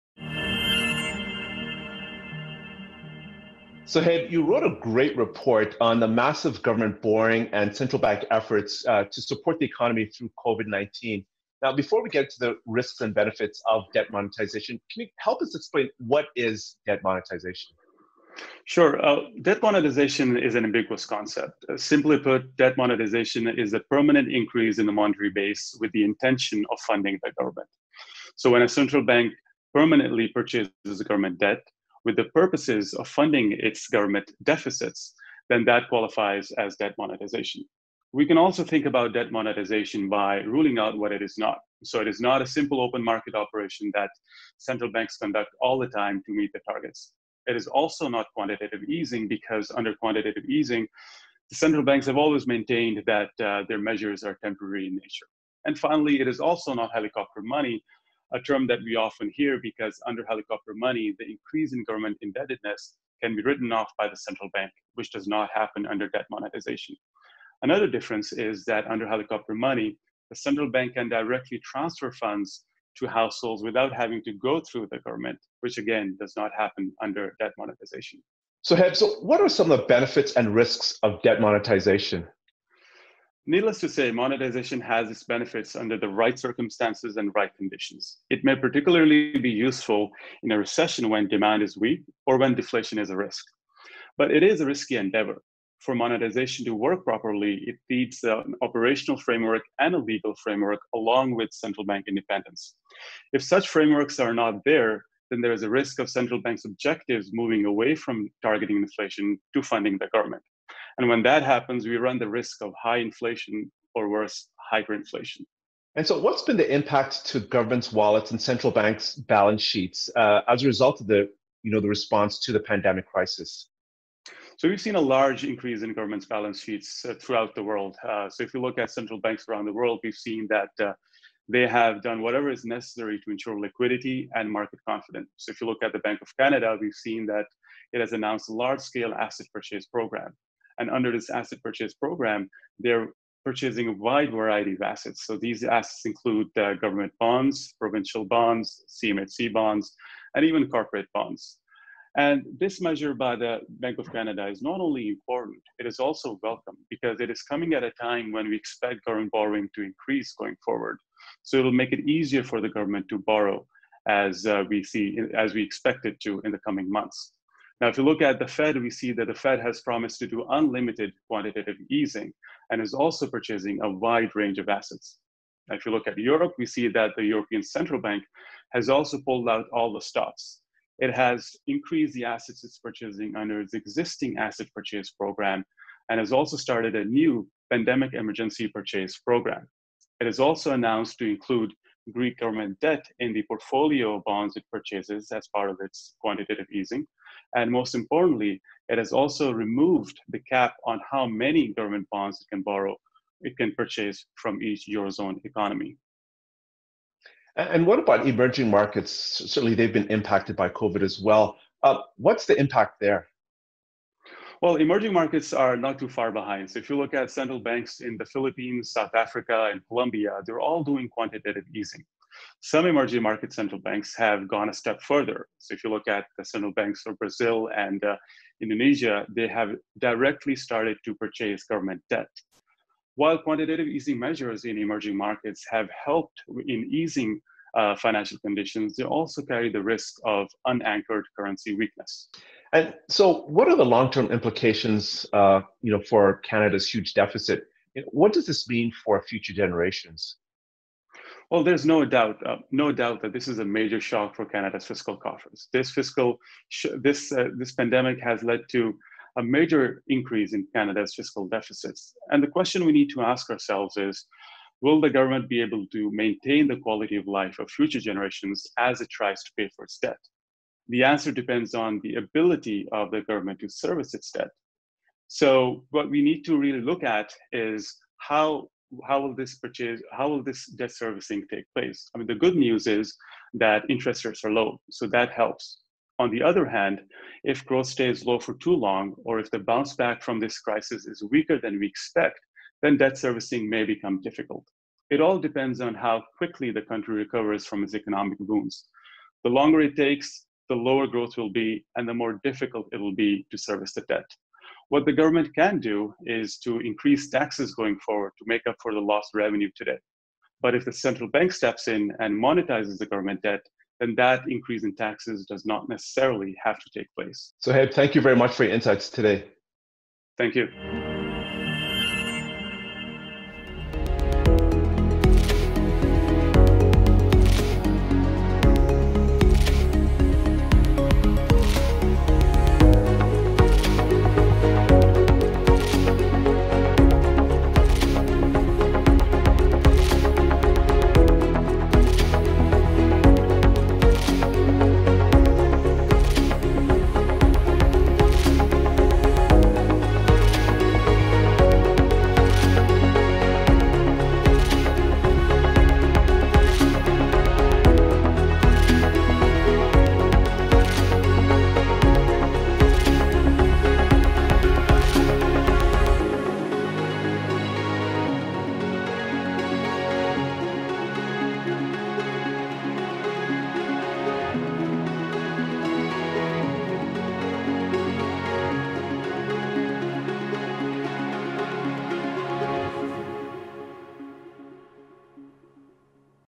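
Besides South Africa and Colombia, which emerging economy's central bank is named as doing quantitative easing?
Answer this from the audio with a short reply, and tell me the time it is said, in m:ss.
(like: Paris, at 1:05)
the Philippines, at 3:38.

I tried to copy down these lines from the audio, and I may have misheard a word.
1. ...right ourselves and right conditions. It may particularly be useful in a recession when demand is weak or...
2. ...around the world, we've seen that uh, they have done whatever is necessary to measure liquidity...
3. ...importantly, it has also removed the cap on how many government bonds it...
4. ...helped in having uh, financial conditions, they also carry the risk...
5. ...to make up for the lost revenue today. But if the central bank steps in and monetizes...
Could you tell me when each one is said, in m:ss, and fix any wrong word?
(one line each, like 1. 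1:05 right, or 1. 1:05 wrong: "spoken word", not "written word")
1. 1:26 wrong: "circumstances", not "ourselves"
2. 2:09 wrong: "ensure", not "measure"
3. 3:17 right
4. 3:56 wrong: "easing", not "having"
5. 5:08 right.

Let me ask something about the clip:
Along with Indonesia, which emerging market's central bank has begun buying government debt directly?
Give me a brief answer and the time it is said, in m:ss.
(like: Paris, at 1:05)
Brazil, at 3:47.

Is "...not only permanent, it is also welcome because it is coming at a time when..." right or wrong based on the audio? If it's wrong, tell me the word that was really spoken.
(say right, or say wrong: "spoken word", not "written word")
wrong: "important", not "permanent".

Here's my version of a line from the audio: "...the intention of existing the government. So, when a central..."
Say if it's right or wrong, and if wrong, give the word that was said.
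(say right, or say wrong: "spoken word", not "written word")
wrong: "funding", not "existing".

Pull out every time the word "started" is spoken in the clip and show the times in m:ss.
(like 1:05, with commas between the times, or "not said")
3:06, 3:50.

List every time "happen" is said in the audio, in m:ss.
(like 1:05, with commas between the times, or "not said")
1:05, 1:16, 1:51.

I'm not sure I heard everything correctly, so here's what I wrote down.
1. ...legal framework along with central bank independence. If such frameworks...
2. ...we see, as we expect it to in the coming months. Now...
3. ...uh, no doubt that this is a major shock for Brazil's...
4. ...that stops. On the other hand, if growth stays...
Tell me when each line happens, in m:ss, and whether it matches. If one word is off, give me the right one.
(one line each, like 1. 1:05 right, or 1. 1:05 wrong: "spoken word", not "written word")
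1. 1:39 right
2. 2:44 right
3. 4:12 wrong: "Canada", not "Brazil"
4. 4:45 wrong: "helps", not "stops".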